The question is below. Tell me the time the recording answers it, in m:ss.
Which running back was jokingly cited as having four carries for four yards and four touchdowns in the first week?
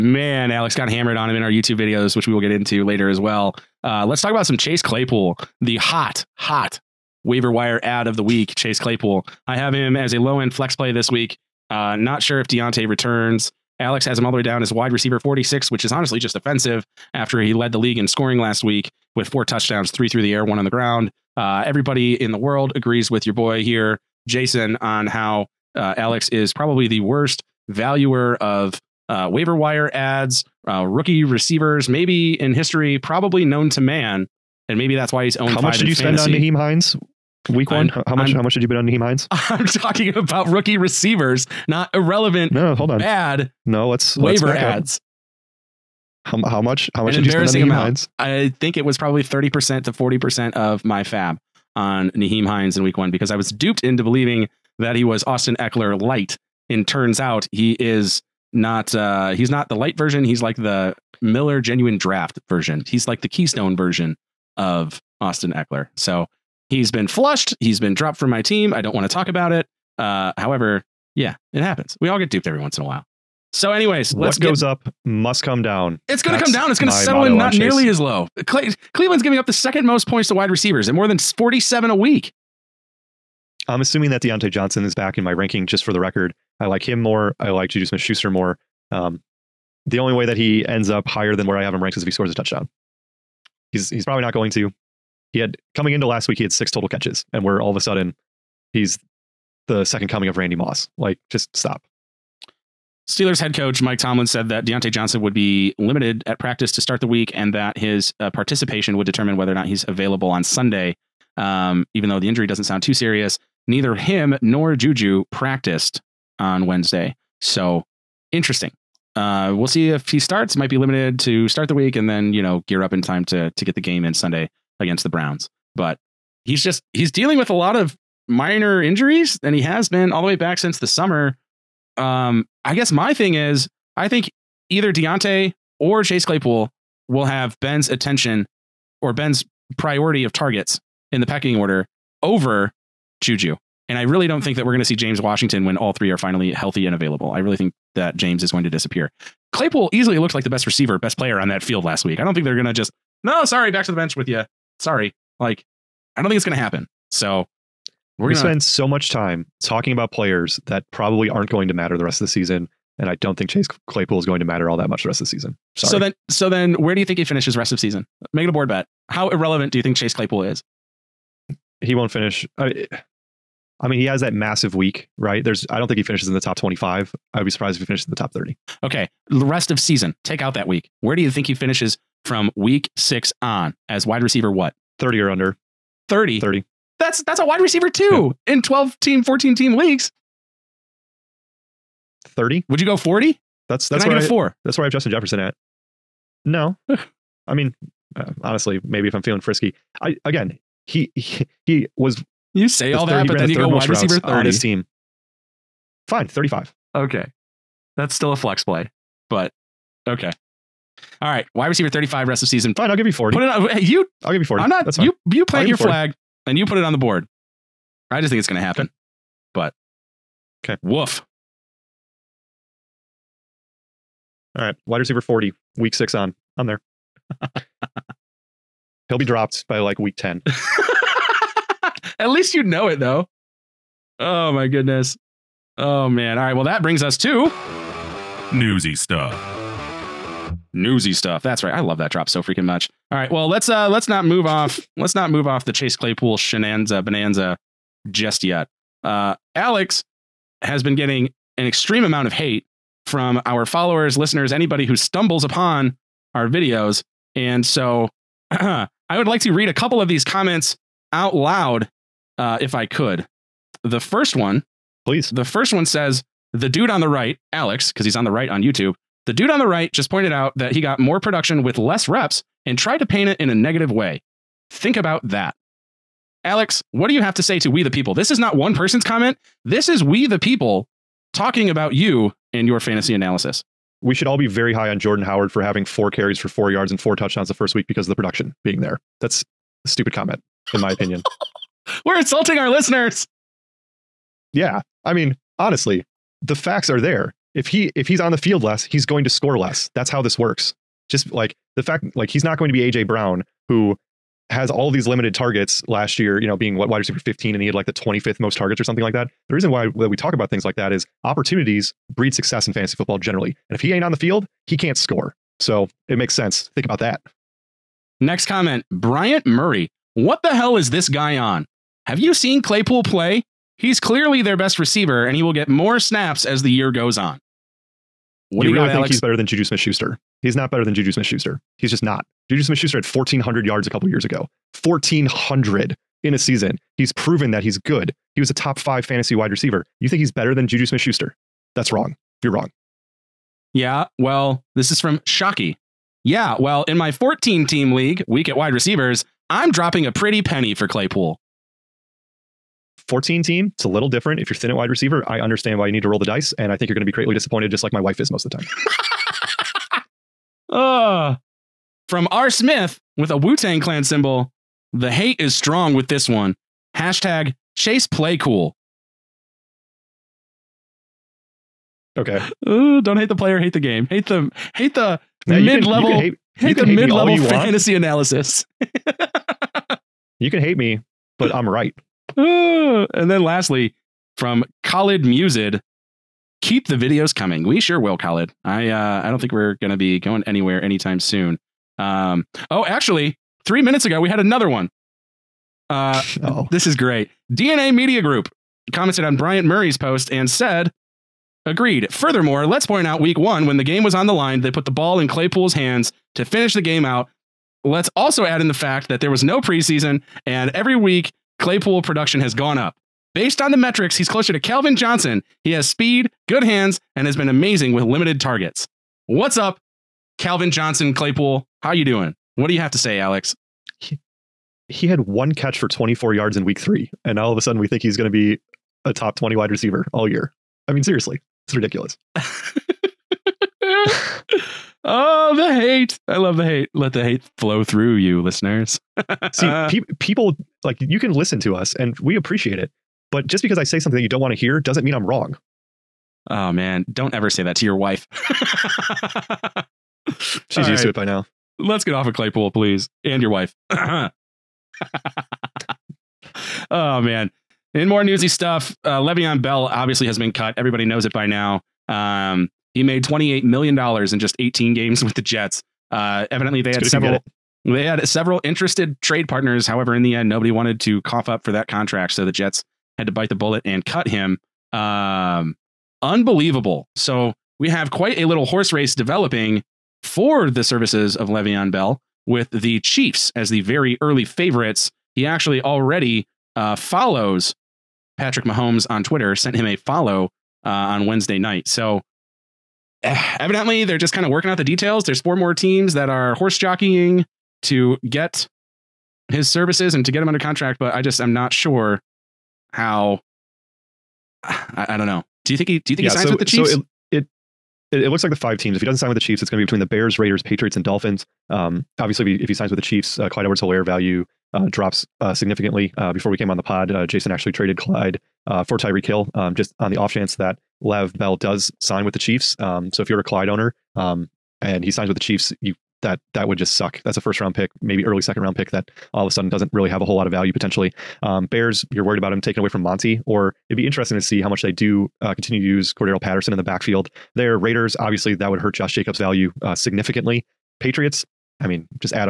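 4:44.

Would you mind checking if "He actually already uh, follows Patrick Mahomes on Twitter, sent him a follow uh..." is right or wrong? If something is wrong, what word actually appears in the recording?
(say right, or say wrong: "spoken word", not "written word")
right.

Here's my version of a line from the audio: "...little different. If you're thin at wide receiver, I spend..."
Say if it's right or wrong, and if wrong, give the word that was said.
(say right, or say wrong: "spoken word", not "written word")
wrong: "understand", not "spend".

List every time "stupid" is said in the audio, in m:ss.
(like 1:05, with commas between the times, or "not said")
4:49.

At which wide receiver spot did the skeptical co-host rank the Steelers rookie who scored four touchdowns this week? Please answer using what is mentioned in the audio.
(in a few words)
46.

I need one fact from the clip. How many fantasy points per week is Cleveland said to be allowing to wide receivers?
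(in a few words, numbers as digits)
47.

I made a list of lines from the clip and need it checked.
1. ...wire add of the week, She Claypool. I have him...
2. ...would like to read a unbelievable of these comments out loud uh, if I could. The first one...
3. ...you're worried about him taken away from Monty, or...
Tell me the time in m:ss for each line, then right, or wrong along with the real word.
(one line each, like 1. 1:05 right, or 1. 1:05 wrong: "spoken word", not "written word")
1. 0:07 wrong: "Chase", not "She"
2. 4:19 wrong: "couple", not "unbelievable"
3. 8:52 right.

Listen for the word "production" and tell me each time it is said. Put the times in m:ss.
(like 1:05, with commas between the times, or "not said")
4:31, 4:48, 6:52.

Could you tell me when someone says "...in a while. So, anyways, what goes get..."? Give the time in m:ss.
1:12.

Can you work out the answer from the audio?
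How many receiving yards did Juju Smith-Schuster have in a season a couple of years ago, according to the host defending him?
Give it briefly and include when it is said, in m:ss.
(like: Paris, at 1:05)
1,400, at 5:33.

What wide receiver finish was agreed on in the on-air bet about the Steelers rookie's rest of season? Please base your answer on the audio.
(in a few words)
40.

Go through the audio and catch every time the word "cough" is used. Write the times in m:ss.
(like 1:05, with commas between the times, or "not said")
7:51.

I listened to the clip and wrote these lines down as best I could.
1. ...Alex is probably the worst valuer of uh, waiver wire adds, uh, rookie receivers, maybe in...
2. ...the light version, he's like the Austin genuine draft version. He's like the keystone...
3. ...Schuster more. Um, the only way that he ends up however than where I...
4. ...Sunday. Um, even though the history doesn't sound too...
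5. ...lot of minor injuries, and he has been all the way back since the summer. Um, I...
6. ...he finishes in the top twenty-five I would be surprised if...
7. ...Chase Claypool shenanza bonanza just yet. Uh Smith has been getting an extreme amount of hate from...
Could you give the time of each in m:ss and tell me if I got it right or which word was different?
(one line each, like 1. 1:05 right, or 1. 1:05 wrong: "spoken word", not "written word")
1. 0:25 right
2. 0:59 wrong: "Miller", not "Austin"
3. 1:27 wrong: "higher", not "however"
4. 1:50 wrong: "injury", not "history"
5. 2:07 right
6. 2:55 right
7. 4:05 wrong: "Alex", not "Smith".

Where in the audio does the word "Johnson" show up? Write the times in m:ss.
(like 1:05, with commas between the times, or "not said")
1:24, 1:44, 6:54, 7:00.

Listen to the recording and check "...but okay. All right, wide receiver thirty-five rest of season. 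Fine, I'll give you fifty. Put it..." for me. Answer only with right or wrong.
wrong.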